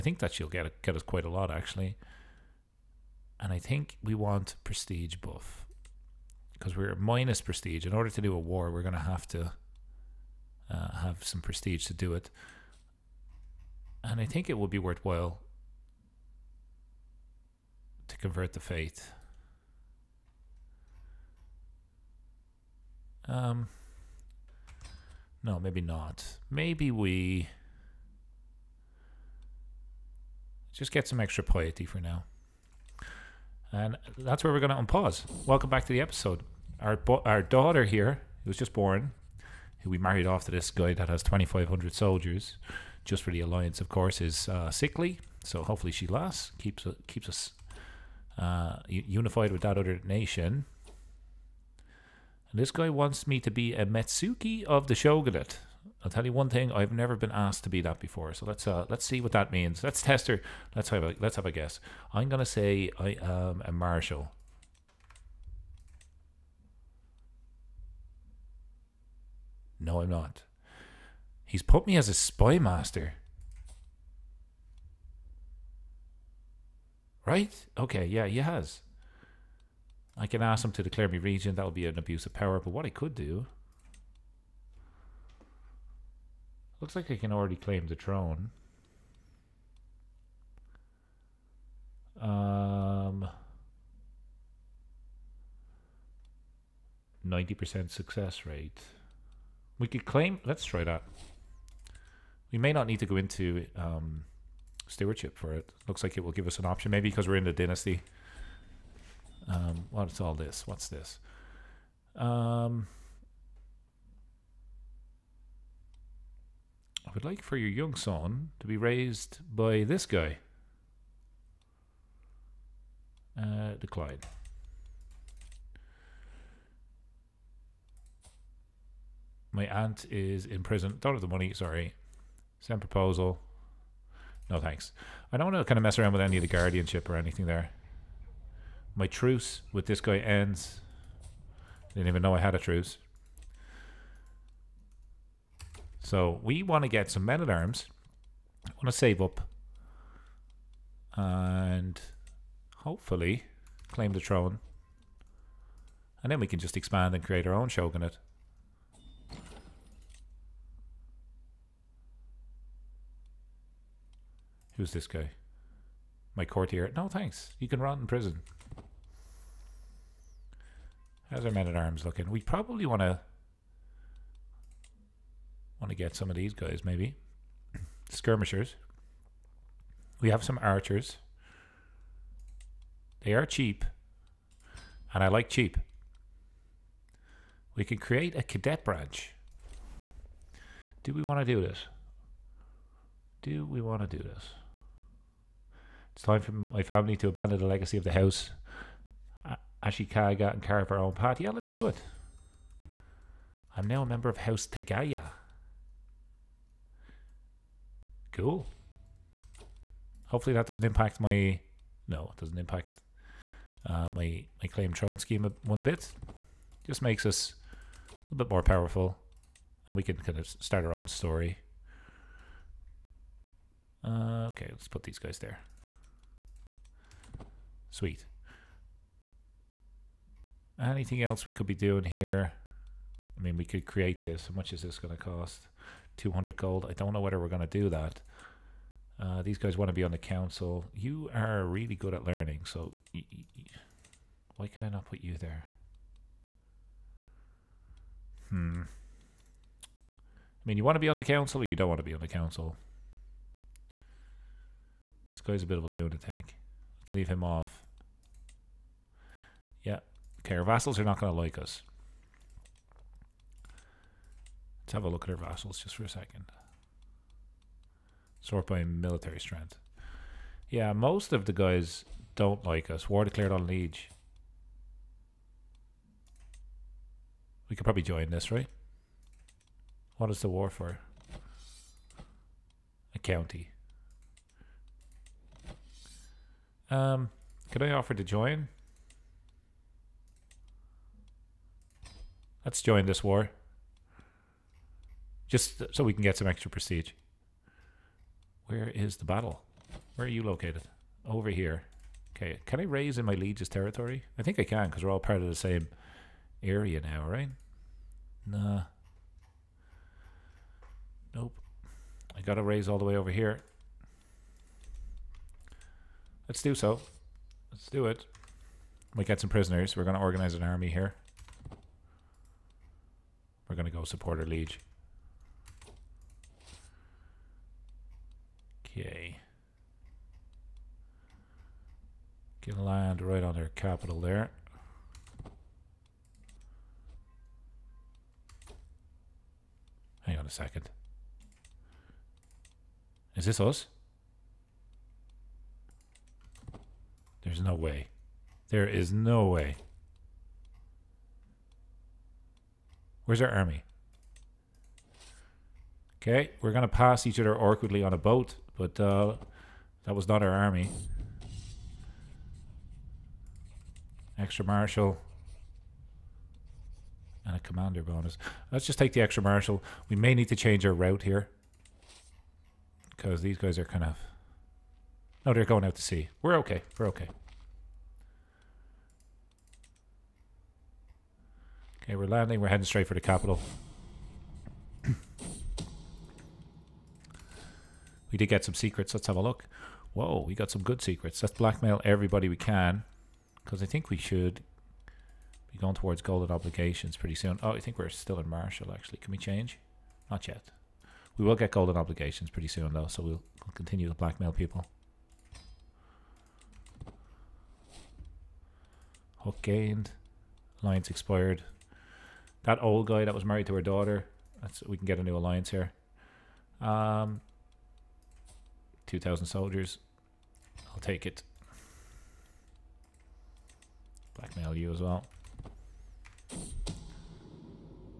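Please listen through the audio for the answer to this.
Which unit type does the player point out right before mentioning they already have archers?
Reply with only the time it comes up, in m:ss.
2:58.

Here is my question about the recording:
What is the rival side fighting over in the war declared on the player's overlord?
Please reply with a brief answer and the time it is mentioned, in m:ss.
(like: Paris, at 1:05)
A county, at 4:43.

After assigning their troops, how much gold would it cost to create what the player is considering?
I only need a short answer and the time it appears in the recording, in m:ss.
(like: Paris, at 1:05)
200 gold, at 3:56.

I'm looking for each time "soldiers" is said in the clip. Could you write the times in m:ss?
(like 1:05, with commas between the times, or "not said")
0:41, 6:59.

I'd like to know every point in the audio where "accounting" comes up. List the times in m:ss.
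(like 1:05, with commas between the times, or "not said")
not said.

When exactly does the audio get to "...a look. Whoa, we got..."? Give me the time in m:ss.
6:29.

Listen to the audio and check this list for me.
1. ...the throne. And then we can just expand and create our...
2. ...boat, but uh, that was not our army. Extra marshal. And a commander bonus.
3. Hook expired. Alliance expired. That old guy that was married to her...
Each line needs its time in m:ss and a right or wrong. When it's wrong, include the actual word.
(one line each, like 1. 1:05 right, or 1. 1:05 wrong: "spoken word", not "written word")
1. 2:34 right
2. 5:58 right
3. 6:49 wrong: "gained", not "expired".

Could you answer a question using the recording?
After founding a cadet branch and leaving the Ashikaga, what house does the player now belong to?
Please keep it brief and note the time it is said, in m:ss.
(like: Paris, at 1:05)
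House Tagaya, at 3:24.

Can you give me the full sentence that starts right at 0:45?
So hopefully she lasts, keeps uh, keeps us uh, unified with that other nation.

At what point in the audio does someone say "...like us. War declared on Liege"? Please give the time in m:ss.
4:32.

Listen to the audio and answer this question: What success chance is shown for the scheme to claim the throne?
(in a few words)
90%.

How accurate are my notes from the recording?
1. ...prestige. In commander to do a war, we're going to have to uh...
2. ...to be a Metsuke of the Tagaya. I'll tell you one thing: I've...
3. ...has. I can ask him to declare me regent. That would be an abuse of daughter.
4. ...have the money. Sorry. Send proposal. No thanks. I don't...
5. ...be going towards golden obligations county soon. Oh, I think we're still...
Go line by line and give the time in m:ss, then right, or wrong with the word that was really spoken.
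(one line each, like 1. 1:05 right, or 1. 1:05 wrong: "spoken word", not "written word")
1. 0:07 wrong: "order", not "commander"
2. 0:53 wrong: "Shogunate", not "Tagaya"
3. 1:18 wrong: "power", not "daughter"
4. 2:11 right
5. 6:35 wrong: "pretty", not "county".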